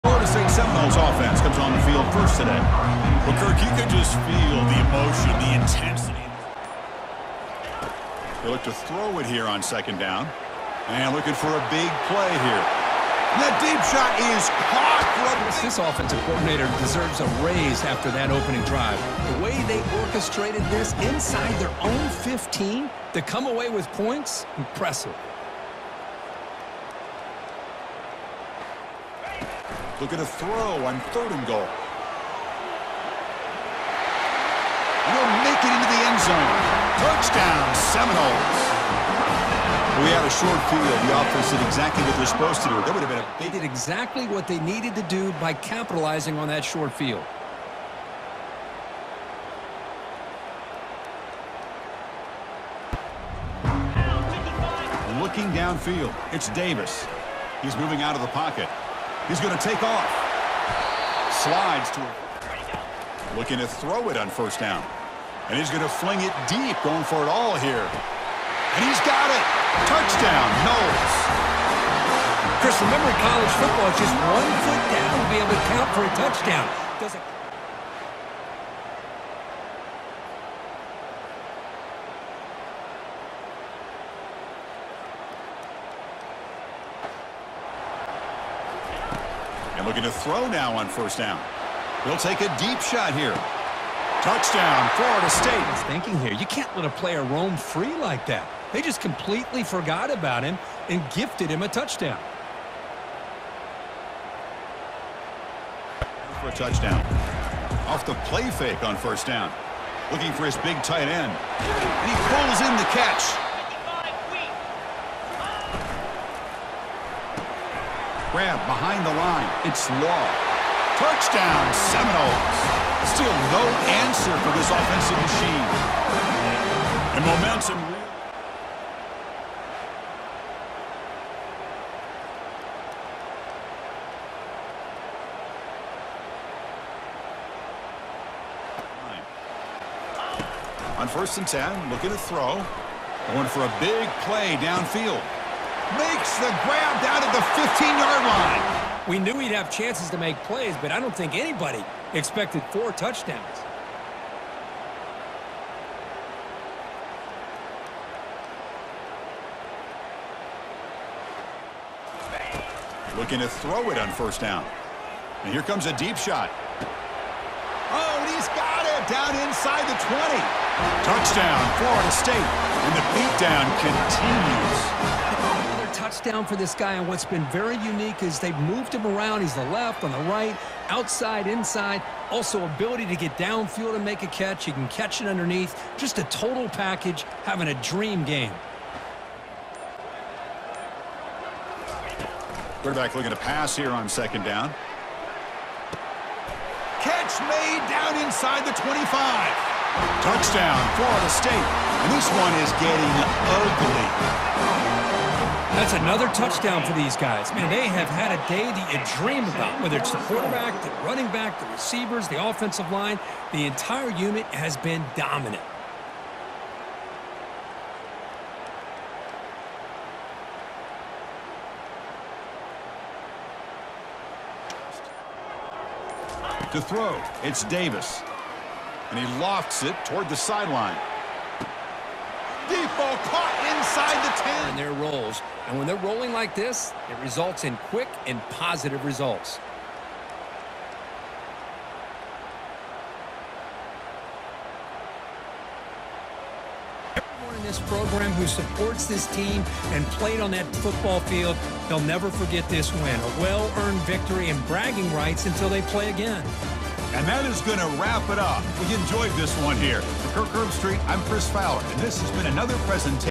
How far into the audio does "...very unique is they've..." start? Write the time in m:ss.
2:57.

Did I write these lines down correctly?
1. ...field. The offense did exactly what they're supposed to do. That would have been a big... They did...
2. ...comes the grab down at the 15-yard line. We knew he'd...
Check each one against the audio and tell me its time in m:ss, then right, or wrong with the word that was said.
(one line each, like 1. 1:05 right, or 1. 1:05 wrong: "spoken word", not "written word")
1. 0:40 right
2. 2:25 wrong: "makes", not "comes".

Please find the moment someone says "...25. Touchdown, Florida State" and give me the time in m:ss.
3:18.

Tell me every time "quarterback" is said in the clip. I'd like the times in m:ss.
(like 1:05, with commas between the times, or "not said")
3:12, 3:30.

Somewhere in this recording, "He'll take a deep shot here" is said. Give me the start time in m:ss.
1:32.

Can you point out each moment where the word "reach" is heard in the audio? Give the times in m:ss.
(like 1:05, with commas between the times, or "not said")
not said.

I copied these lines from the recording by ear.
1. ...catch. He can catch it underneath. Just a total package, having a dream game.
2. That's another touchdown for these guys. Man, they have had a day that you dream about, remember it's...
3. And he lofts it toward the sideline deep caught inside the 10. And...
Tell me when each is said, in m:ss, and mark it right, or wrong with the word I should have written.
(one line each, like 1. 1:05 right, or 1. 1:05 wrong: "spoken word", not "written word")
1. 3:04 right
2. 3:25 wrong: "whether", not "remember"
3. 3:49 right.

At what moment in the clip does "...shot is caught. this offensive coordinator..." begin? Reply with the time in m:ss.
0:13.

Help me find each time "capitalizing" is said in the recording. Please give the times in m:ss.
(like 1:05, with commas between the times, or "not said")
0:45.